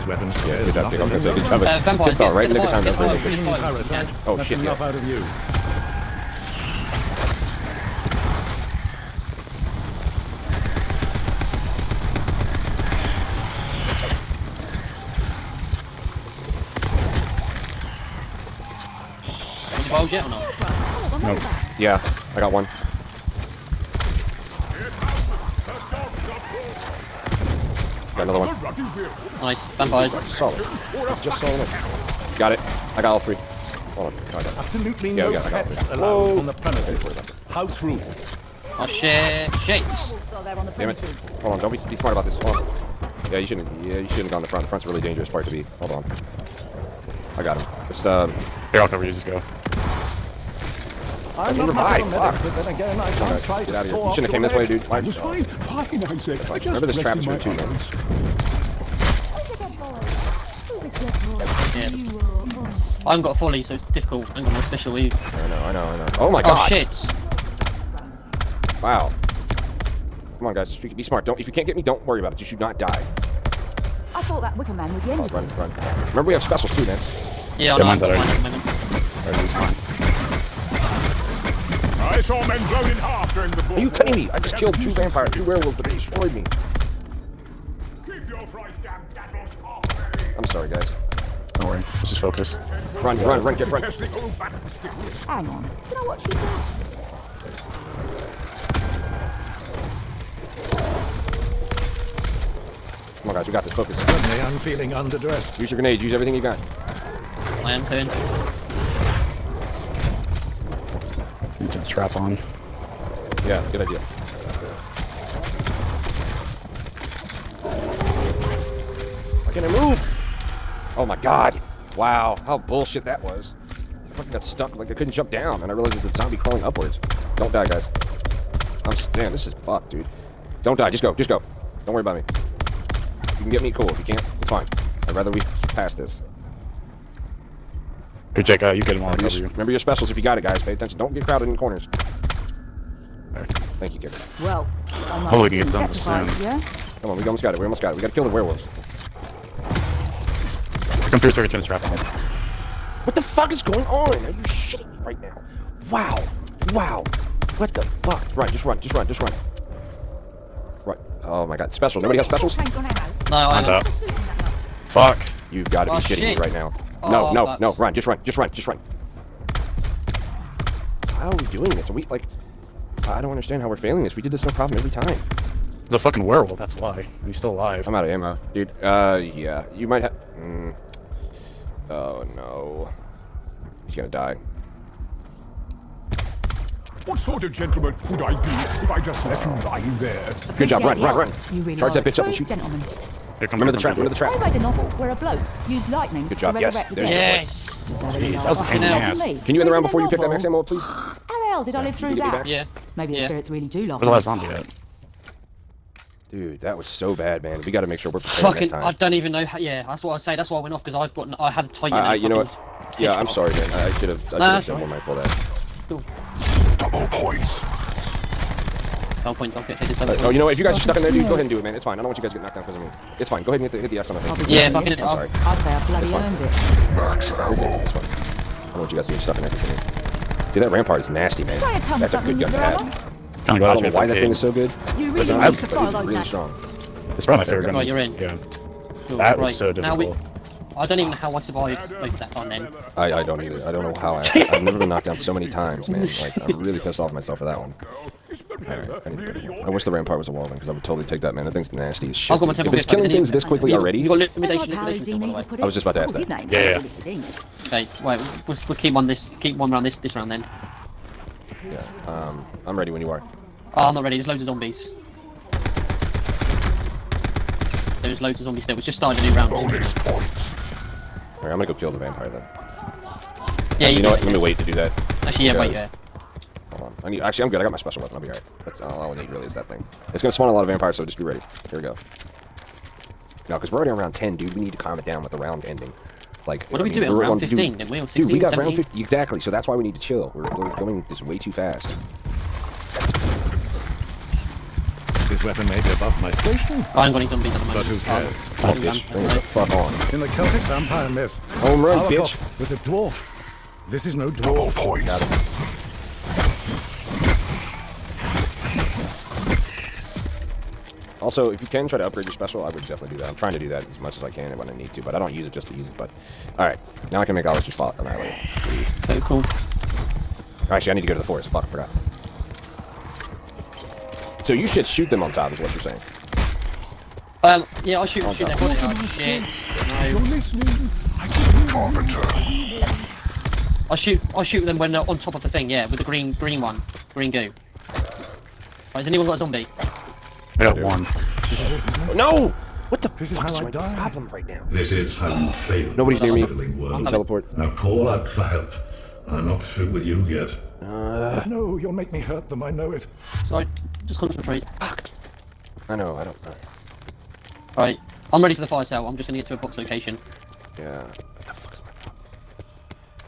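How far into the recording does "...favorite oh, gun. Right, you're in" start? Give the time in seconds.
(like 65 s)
237 s.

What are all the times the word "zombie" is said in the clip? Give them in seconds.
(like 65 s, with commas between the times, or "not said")
126 s, 204 s, 264 s, 268 s, 297 s, 339 s.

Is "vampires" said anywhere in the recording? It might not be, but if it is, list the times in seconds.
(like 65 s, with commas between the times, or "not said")
1 s, 29 s, 84 s, 271 s, 280 s, 300 s.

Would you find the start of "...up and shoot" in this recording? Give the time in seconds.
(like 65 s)
192 s.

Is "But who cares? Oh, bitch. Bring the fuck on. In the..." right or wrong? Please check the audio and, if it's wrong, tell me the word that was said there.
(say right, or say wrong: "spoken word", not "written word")
right.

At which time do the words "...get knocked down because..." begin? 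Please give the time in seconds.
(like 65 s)
222 s.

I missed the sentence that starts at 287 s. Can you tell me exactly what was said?
Dude, we on 16, dude, we got 17?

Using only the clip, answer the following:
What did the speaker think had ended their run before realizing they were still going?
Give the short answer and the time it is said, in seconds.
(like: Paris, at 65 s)
Wicker Man, at 74 s.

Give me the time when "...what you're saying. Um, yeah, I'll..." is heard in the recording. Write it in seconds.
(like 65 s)
325 s.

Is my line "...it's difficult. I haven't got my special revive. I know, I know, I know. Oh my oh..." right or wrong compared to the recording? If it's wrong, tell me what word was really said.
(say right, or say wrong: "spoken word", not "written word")
wrong: "weave", not "revive".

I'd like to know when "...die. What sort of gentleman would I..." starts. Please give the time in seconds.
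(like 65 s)
184 s.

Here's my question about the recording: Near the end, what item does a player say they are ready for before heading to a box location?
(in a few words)
fire cell.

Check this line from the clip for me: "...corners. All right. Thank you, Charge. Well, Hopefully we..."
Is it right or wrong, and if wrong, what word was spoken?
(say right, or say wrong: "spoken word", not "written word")
wrong: "Kicker", not "Charge".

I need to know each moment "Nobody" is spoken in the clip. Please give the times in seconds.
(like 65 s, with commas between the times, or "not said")
162 s, 345 s.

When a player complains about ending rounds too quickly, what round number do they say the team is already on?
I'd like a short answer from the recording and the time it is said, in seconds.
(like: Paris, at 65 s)
10, at 283 s.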